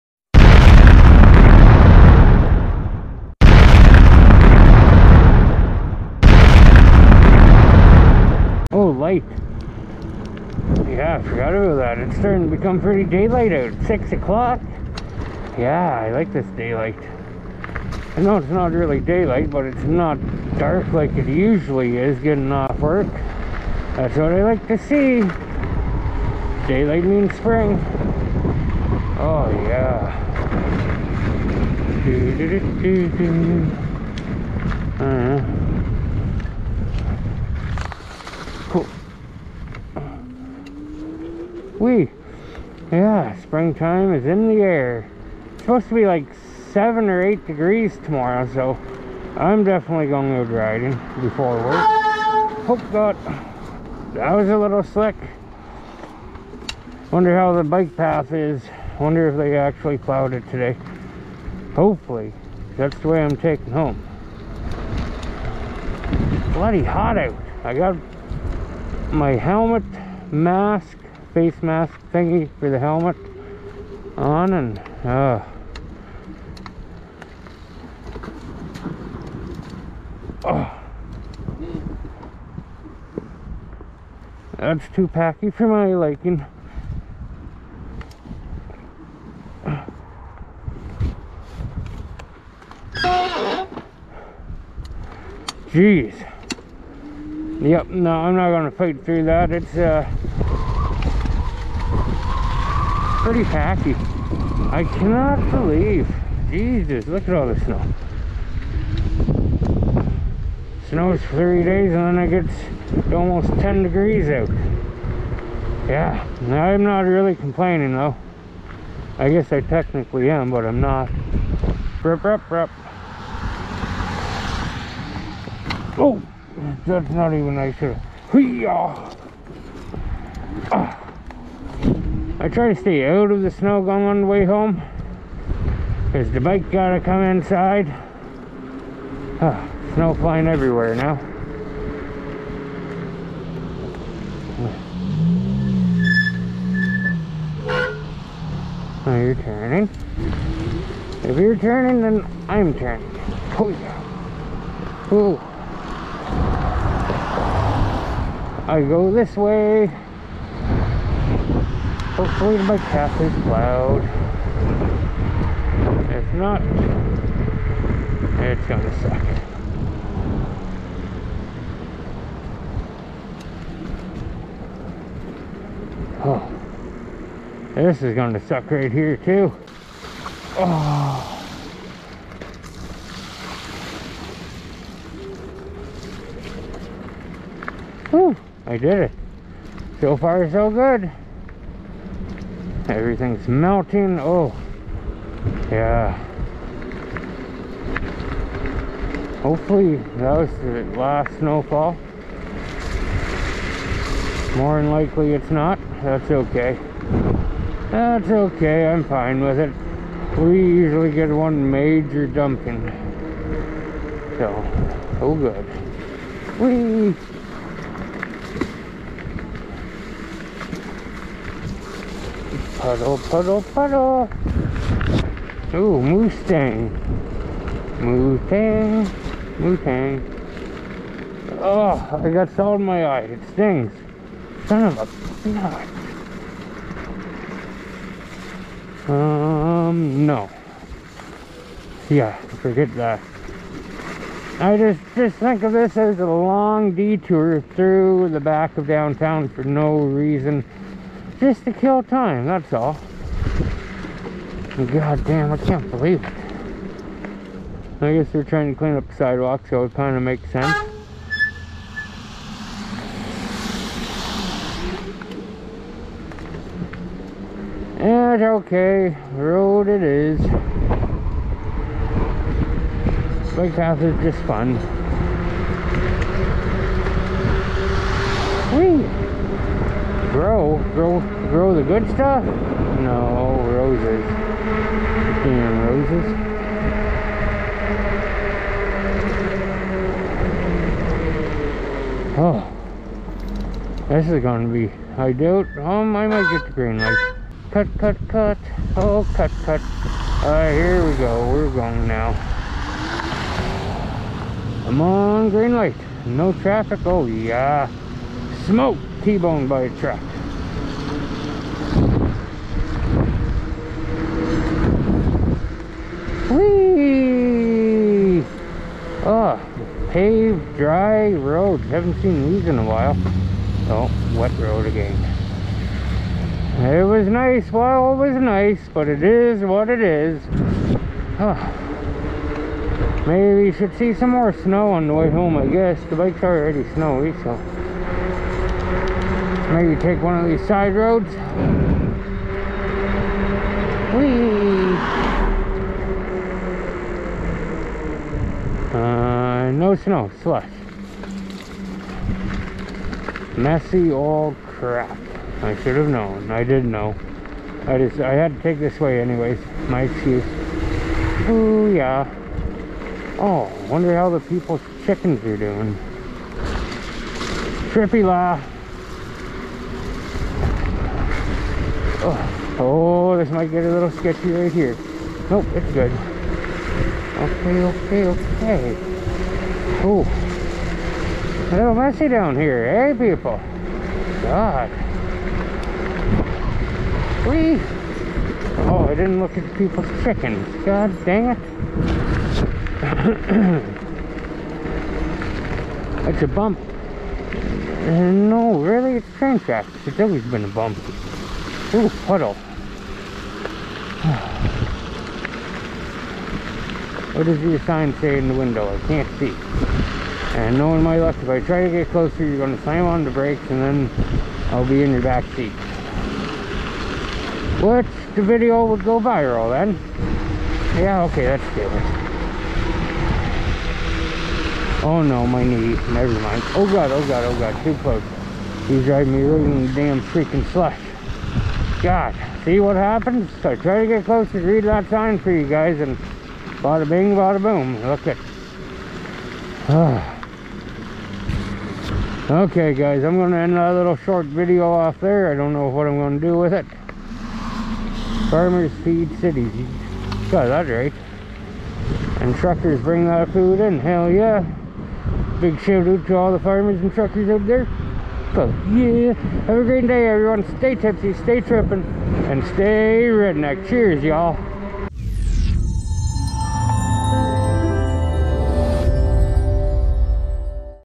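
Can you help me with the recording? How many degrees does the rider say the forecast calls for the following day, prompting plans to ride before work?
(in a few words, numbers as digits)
7 or 8.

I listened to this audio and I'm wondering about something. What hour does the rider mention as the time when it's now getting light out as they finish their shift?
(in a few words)
6 o'clock.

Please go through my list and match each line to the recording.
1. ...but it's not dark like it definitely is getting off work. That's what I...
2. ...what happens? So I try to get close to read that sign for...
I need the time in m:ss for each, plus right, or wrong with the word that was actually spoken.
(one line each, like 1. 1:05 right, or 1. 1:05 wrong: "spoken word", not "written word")
1. 0:19 wrong: "usually", not "definitely"
2. 7:12 right.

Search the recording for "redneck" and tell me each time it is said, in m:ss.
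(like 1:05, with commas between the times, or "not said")
7:43.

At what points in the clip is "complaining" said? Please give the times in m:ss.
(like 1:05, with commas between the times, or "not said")
1:57.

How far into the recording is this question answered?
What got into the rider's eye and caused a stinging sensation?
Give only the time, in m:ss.
3:52.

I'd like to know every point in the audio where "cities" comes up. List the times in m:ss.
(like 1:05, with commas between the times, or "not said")
7:29.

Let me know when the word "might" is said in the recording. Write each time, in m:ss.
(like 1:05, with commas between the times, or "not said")
4:56, 6:13.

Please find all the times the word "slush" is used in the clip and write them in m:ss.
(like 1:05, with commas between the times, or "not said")
5:50, 7:10.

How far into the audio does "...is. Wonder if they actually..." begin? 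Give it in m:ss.
0:58.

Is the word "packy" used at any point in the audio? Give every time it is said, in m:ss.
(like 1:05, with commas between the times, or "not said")
1:25, 1:43.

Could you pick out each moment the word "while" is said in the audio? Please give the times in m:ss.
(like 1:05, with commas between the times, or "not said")
5:22, 5:27.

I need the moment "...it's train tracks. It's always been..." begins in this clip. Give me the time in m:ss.
6:39.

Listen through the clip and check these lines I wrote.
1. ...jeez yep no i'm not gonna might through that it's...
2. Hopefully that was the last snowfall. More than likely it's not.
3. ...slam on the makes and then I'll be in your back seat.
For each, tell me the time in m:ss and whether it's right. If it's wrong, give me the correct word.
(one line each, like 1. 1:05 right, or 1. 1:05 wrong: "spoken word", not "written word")
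1. 1:35 wrong: "fight", not "might"
2. 3:19 right
3. 6:52 wrong: "brakes", not "makes".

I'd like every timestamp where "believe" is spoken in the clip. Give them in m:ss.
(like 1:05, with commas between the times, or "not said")
1:45, 4:15.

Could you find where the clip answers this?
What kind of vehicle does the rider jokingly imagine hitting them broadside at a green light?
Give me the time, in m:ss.
5:09.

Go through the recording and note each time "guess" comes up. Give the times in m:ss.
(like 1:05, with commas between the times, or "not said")
1:59, 4:18, 5:35.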